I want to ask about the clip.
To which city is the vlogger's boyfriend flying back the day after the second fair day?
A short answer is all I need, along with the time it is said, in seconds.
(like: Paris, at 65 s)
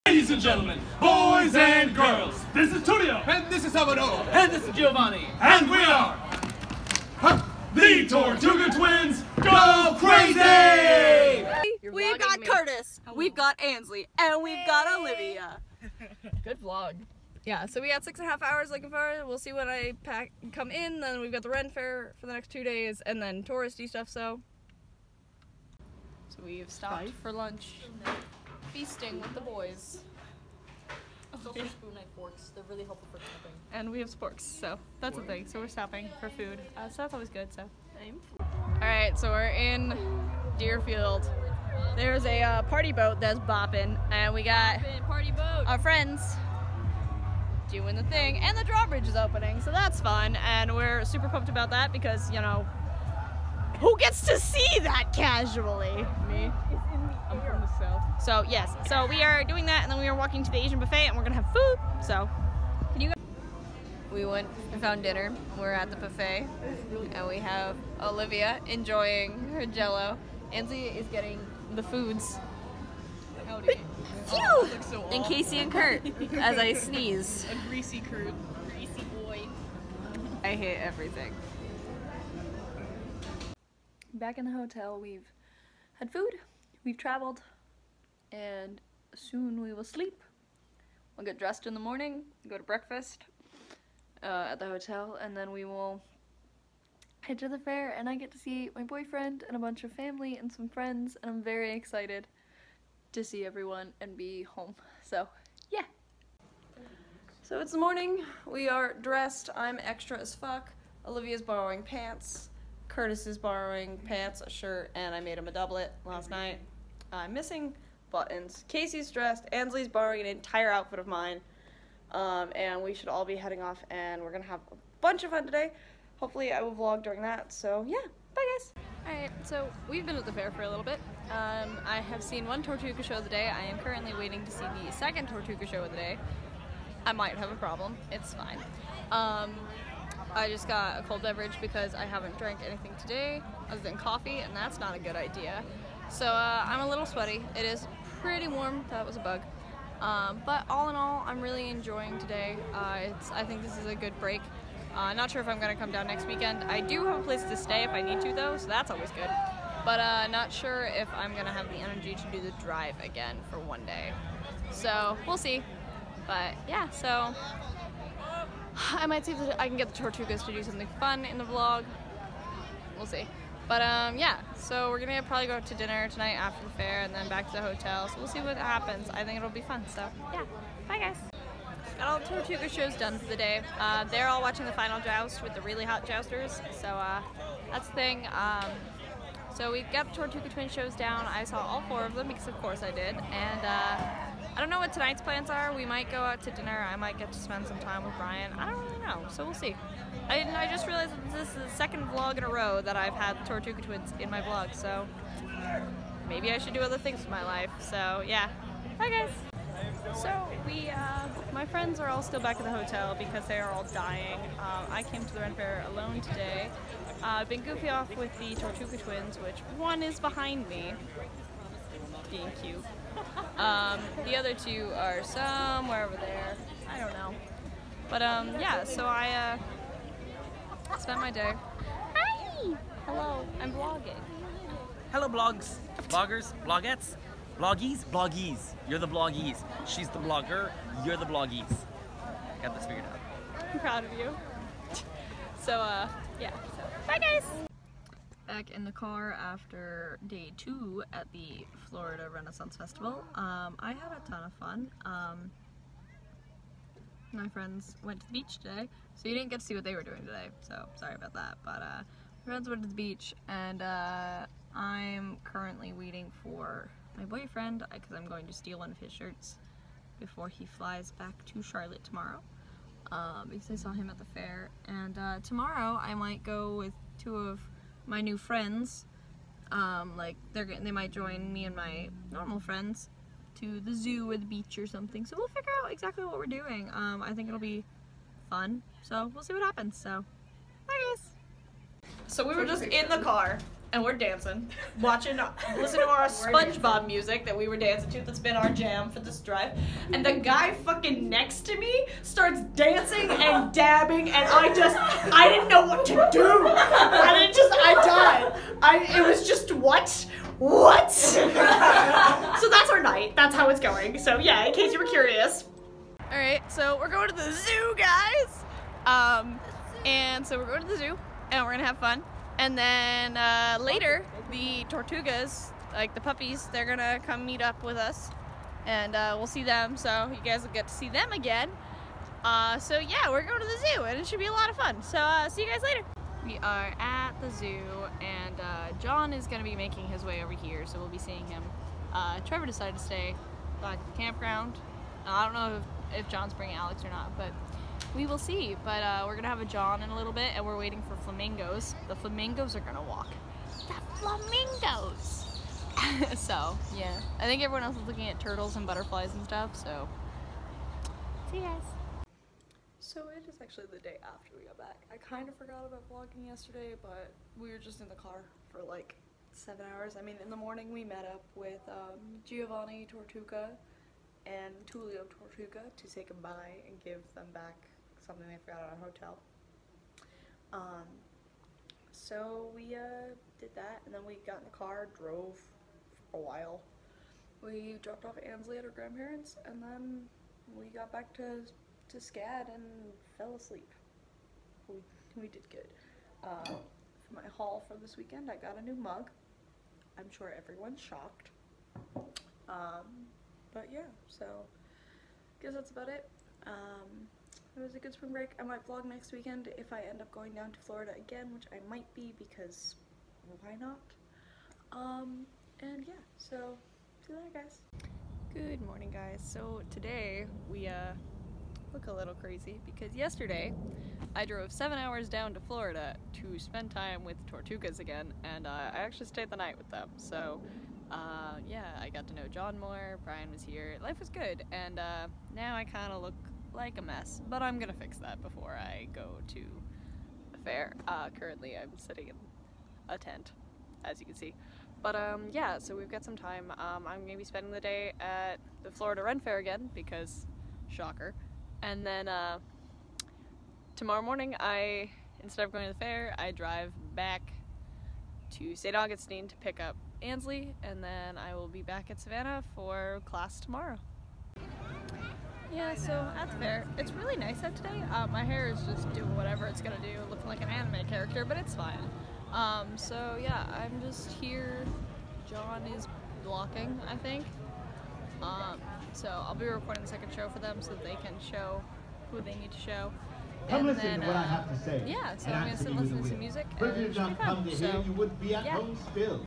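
Charlotte, at 271 s.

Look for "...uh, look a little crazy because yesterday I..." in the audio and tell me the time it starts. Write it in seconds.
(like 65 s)
420 s.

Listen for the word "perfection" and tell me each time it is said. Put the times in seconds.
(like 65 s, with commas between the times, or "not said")
not said.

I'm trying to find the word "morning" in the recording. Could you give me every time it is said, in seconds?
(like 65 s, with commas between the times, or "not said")
91 s, 107 s, 370 s, 418 s, 454 s.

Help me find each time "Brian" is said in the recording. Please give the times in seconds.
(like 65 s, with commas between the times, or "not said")
198 s, 433 s.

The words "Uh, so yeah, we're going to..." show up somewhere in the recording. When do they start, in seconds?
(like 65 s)
332 s.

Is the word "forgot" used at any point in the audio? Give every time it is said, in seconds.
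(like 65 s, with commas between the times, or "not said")
365 s, 378 s.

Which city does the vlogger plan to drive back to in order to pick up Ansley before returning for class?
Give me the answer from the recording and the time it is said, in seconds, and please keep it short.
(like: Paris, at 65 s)
St. Augustine, at 458 s.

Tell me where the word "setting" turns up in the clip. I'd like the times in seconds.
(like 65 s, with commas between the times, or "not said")
not said.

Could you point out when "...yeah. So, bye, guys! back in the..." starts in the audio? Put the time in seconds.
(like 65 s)
246 s.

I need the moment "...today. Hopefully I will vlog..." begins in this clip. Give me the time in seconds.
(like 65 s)
125 s.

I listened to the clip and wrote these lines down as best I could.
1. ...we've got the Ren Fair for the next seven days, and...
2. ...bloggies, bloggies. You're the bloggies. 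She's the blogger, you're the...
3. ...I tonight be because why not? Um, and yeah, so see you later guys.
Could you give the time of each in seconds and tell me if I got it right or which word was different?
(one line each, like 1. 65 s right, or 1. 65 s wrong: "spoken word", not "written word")
1. 21 s wrong: "two", not "seven"
2. 237 s right
3. 411 s wrong: "might", not "tonight".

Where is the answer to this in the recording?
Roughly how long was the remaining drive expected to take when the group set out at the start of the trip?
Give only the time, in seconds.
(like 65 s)
18 s.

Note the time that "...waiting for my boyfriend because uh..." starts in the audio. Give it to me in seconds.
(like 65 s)
265 s.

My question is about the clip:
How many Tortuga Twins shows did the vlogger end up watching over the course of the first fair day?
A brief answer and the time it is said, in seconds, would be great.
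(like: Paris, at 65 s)
4, at 191 s.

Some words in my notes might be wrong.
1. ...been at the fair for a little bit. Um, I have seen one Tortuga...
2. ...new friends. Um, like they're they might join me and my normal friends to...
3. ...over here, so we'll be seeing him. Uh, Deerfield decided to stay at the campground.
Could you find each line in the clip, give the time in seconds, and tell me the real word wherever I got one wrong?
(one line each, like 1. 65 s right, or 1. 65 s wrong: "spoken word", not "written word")
1. 130 s right
2. 278 s right
3. 340 s wrong: "Trevor", not "Deerfield".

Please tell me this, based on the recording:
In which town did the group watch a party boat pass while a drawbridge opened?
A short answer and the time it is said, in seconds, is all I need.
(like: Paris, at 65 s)
Deerfield, at 40 s.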